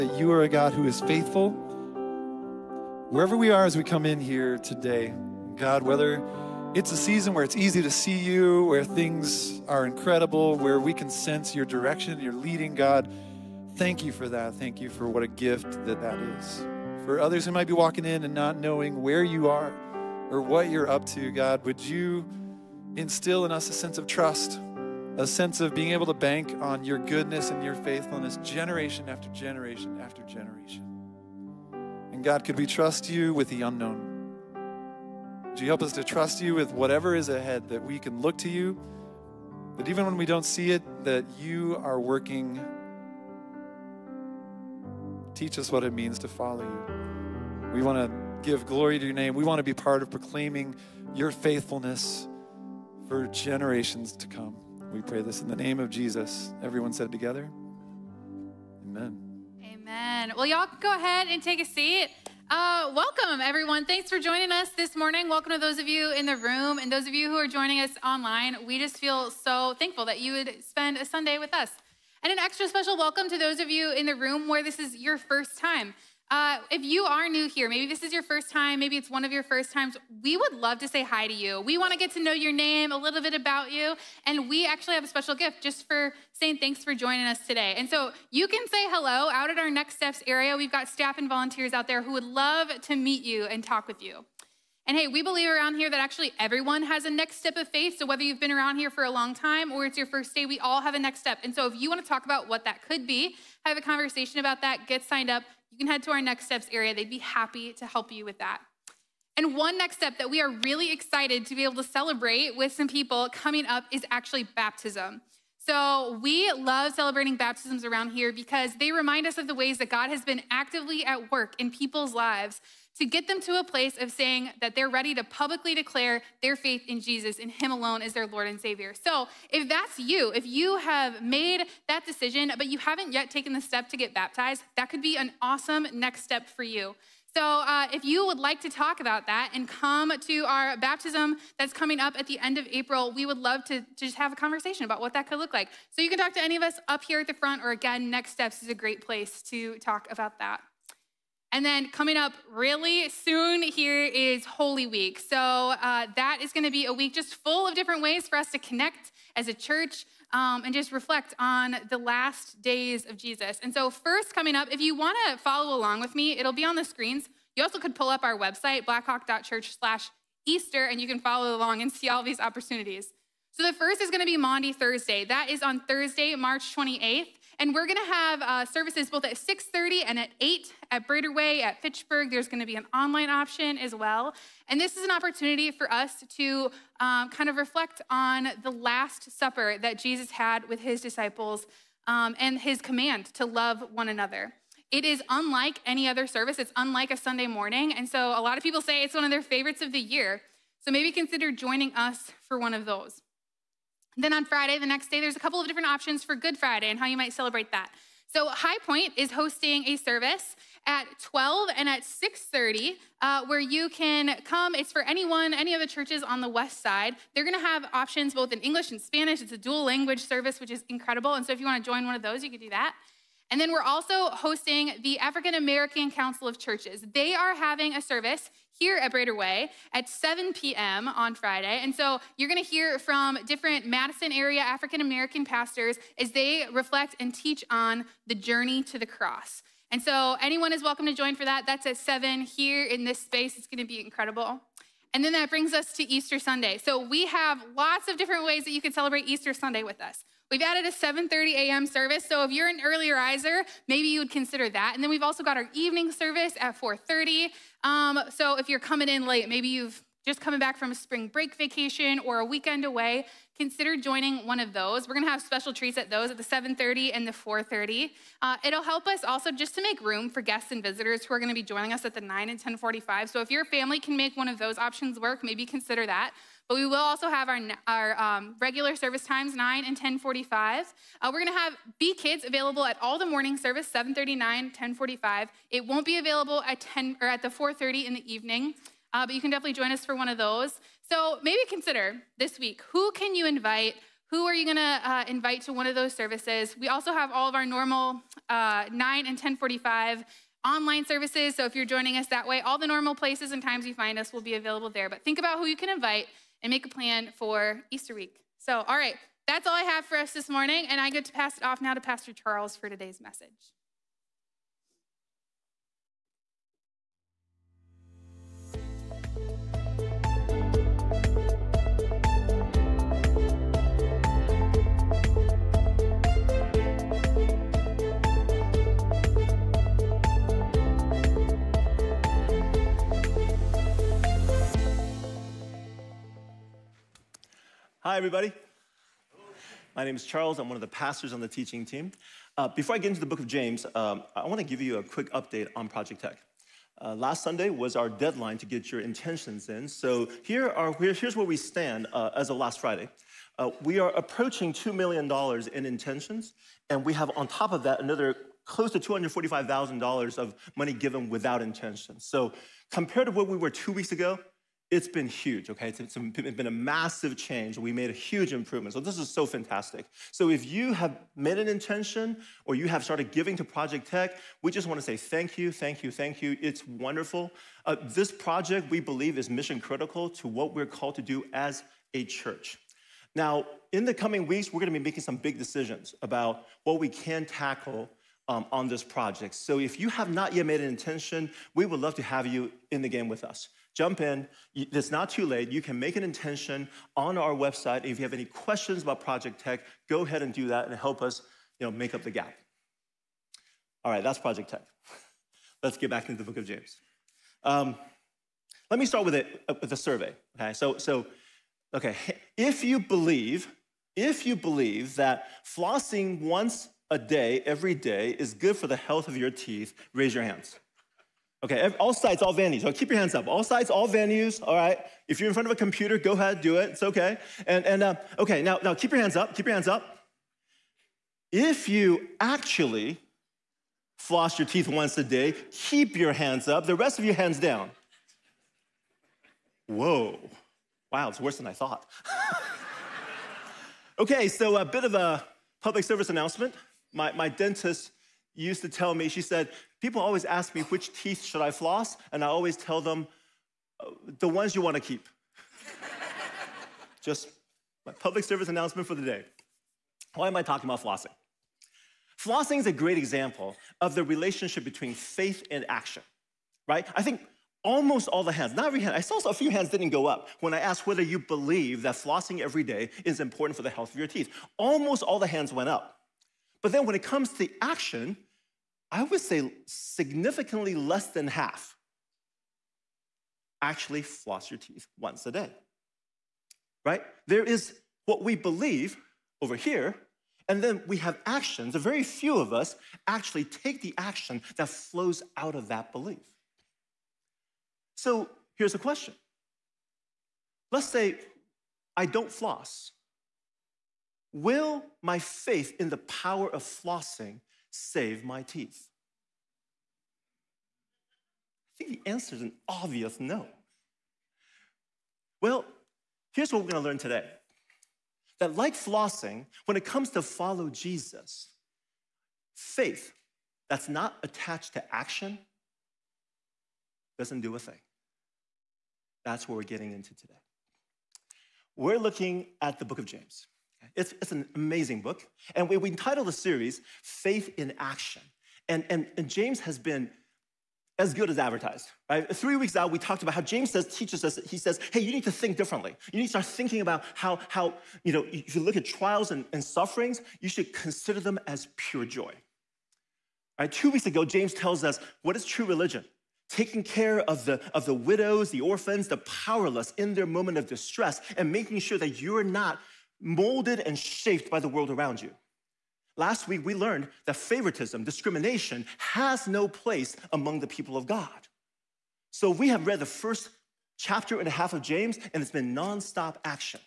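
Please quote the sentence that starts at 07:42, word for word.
Flossing is a great example of the relationship between faith and action, right?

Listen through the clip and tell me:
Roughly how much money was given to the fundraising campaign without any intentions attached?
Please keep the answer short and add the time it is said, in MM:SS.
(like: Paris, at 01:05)
$245,000, at 05:58.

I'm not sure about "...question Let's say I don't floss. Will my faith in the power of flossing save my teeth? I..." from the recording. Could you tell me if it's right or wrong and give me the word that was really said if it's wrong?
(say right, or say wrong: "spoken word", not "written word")
right.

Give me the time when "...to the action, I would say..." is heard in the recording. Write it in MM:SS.
07:57.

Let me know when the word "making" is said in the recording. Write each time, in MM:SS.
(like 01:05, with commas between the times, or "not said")
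06:25, 09:21.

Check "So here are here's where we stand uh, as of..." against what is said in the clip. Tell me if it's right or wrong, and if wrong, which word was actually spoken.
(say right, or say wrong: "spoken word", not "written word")
right.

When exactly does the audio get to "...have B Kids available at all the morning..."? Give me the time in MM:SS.
04:41.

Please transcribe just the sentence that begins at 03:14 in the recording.
It is unlike any other service.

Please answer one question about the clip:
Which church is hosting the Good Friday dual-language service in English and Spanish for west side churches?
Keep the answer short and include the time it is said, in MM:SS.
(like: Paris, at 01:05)
High Point, at 03:28.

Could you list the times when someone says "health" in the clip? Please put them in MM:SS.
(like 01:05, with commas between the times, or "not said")
06:58, 07:53.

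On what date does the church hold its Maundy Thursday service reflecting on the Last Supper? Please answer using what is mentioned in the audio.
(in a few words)
March 28th.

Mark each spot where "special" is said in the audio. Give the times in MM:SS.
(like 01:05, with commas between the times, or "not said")
01:12, 01:25, 04:25.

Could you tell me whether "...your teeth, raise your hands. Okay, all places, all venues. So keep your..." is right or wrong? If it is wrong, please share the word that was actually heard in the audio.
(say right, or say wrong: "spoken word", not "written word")
wrong: "sites", not "places".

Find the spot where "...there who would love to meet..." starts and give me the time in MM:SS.
01:31.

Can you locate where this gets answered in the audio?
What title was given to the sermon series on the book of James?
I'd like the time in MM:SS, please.
08:57.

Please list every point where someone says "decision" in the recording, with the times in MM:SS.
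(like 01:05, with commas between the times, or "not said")
02:12, 06:25.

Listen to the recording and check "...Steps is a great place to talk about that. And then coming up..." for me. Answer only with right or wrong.
right.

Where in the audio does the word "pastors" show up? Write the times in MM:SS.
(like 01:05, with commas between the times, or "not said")
03:55, 05:12, 05:40.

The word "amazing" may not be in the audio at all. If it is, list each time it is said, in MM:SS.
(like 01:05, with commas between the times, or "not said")
08:54.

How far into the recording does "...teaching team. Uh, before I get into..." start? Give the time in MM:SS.
05:41.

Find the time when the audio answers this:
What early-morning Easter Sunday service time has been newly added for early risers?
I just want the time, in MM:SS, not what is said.
04:10.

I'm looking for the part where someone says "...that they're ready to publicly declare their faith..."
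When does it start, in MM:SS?
02:04.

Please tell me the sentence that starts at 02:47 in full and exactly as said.
You also could pull up our website, blackhawk.church/easter, and you can follow along and see all these opportunities.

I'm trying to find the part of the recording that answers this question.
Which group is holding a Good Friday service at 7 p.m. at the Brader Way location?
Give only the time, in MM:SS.
03:45.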